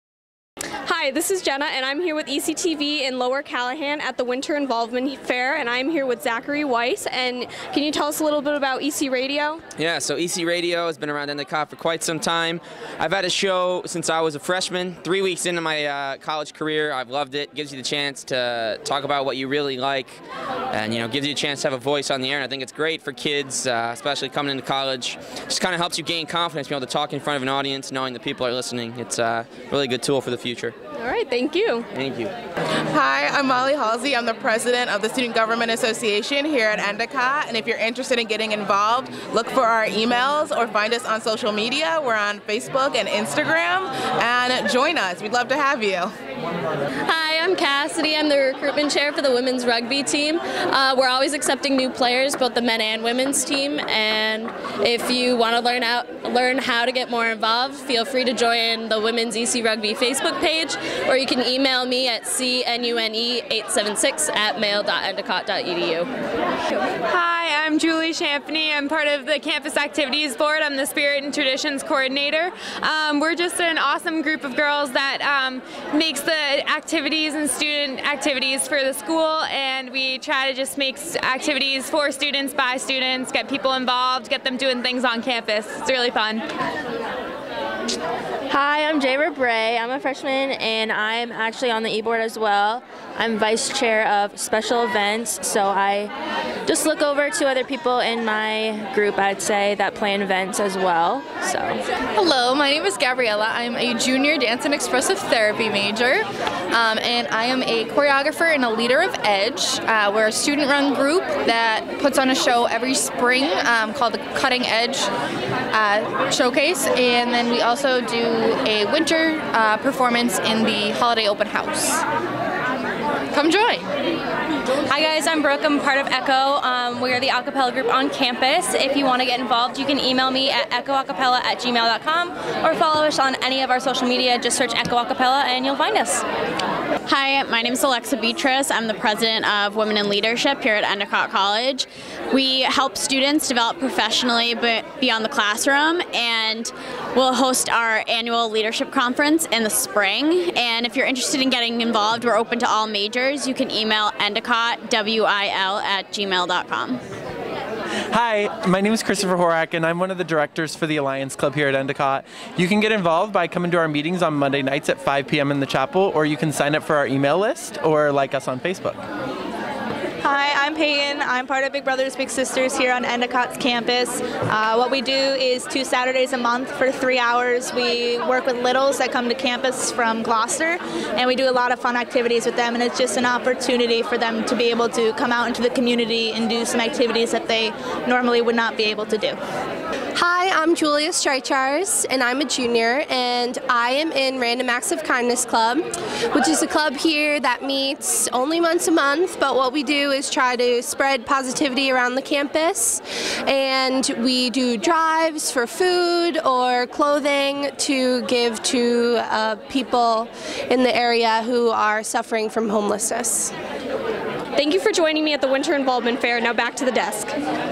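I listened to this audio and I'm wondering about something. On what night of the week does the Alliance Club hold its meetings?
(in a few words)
Monday.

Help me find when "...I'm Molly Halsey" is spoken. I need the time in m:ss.
0:33.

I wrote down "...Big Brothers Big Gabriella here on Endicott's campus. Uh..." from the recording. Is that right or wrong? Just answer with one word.
wrong.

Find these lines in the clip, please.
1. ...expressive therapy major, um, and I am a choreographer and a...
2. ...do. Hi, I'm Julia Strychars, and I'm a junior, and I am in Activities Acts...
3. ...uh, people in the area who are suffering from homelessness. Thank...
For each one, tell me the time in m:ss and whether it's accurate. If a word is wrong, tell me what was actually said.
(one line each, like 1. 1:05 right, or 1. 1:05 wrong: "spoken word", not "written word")
1. 1:44 right
2. 3:09 wrong: "Random", not "Activities"
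3. 3:29 right.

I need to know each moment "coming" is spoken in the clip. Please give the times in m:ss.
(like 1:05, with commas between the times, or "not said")
0:24, 2:43.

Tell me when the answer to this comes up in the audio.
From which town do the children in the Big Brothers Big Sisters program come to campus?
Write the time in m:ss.
3:00.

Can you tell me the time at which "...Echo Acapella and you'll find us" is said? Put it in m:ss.
2:14.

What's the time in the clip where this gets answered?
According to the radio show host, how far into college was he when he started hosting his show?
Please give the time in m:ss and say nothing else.
0:14.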